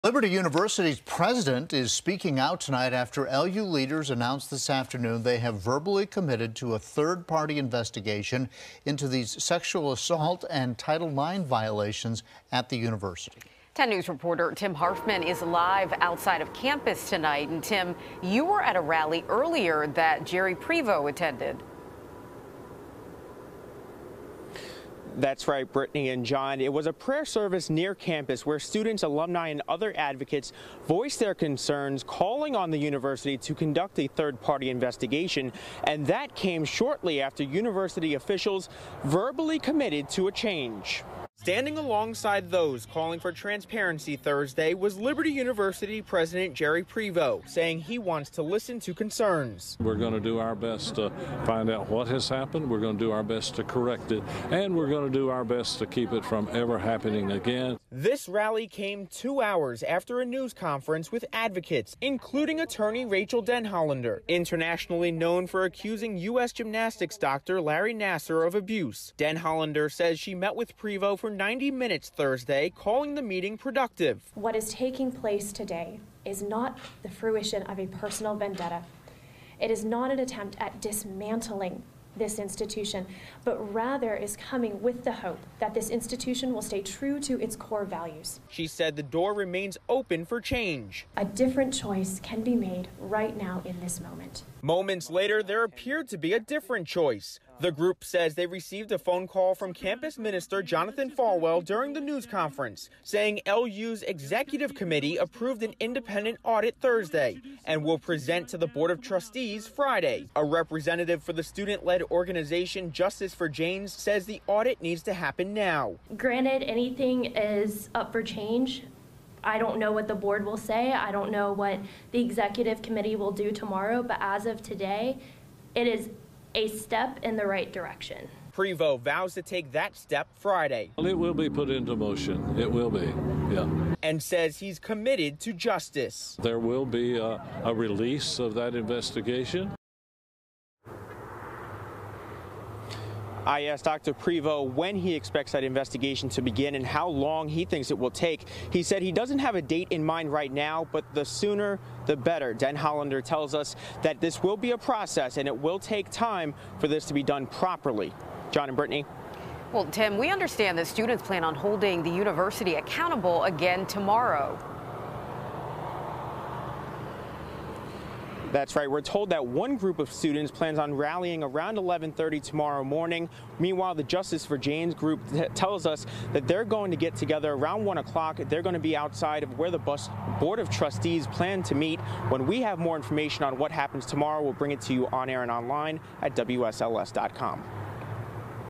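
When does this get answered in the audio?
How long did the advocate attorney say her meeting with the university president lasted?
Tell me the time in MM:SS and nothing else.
01:11.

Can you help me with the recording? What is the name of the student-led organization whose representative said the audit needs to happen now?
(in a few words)
Justice for Janes.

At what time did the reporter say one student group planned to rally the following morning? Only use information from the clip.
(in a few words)
11:30.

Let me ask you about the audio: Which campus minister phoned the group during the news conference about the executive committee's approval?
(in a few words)
Jonathan Falwell.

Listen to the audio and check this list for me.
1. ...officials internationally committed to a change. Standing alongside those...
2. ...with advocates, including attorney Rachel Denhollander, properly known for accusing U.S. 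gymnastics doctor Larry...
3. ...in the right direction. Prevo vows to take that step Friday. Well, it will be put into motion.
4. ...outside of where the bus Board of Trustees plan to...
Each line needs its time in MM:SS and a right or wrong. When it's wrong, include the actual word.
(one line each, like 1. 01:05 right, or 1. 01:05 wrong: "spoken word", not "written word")
1. 00:38 wrong: "verbally", not "internationally"
2. 01:01 wrong: "internationally", not "properly"
3. 02:07 right
4. 02:58 right.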